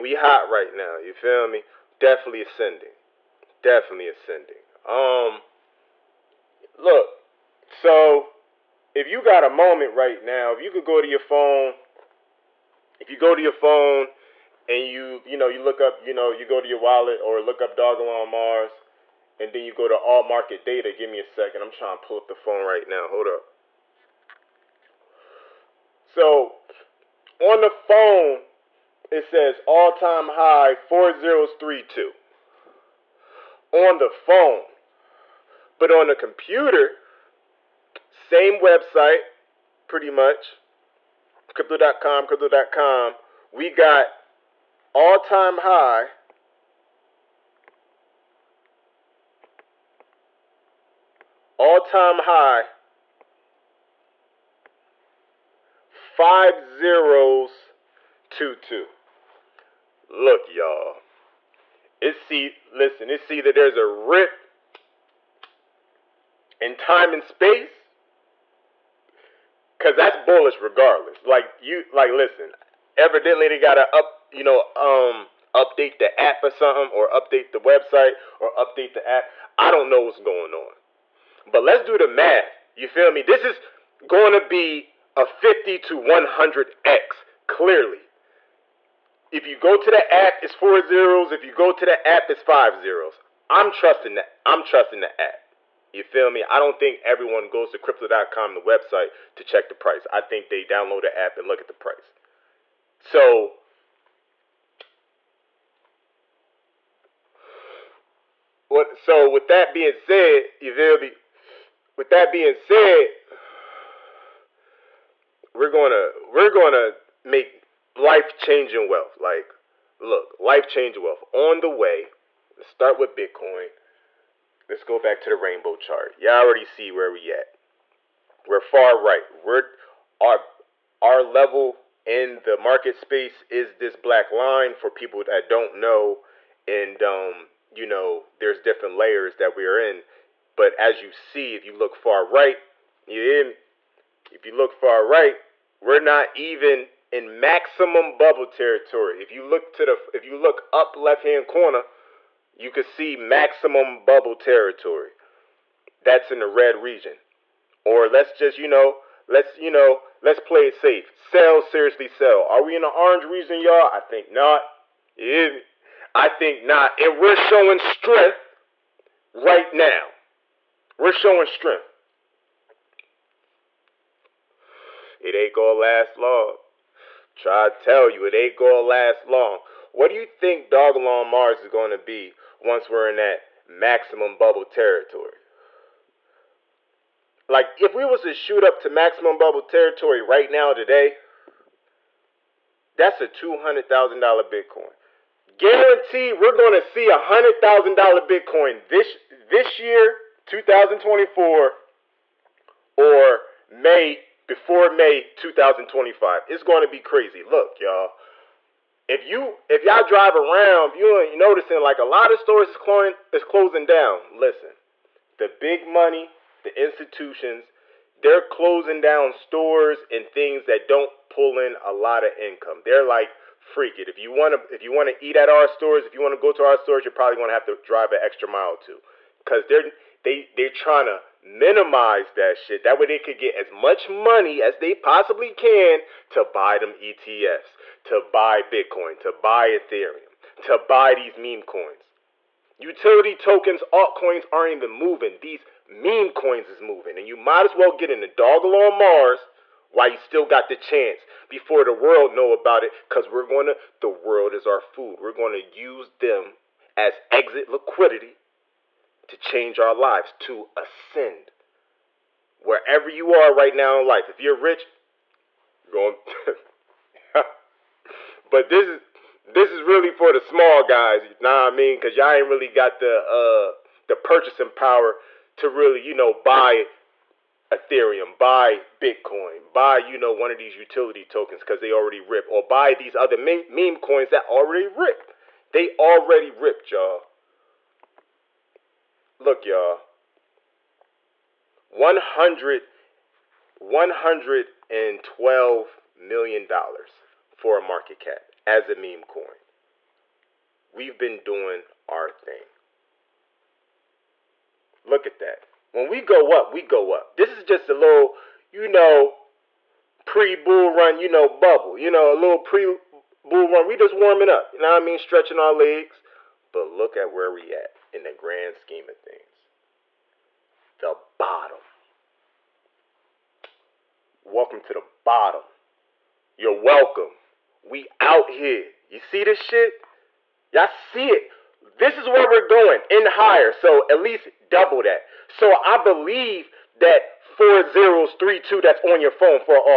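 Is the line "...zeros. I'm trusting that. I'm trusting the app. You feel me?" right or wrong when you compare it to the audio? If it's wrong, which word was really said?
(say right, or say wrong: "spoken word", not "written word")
right.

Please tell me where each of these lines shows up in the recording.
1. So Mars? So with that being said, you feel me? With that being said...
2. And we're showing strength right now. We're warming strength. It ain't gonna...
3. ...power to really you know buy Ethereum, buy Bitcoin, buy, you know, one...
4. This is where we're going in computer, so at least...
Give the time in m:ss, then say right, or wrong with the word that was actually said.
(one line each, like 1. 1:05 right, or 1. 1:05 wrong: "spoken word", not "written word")
1. 1:42 wrong: "What", not "Mars"
2. 2:47 wrong: "showing", not "warming"
3. 4:34 right
4. 5:31 wrong: "higher", not "computer".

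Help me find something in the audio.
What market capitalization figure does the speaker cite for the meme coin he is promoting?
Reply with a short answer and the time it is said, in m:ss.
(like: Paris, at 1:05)
$112 million, at 4:53.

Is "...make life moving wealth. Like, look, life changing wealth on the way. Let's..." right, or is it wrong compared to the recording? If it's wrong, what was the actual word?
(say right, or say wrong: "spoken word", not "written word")
wrong: "changing", not "moving".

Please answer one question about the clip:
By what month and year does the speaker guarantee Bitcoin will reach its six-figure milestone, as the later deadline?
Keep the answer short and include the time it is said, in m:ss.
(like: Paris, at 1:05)
May 2025, at 3:24.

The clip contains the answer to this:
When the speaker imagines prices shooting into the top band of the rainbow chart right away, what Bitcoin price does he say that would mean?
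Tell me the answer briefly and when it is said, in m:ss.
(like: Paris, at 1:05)
$200,000, at 3:13.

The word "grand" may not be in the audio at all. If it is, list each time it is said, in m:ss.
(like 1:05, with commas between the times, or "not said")
5:18.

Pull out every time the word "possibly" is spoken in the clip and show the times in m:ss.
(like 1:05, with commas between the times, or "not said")
3:54.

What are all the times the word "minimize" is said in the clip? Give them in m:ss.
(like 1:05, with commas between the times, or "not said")
3:51.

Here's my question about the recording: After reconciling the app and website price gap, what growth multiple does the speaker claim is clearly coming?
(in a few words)
50 to 100x.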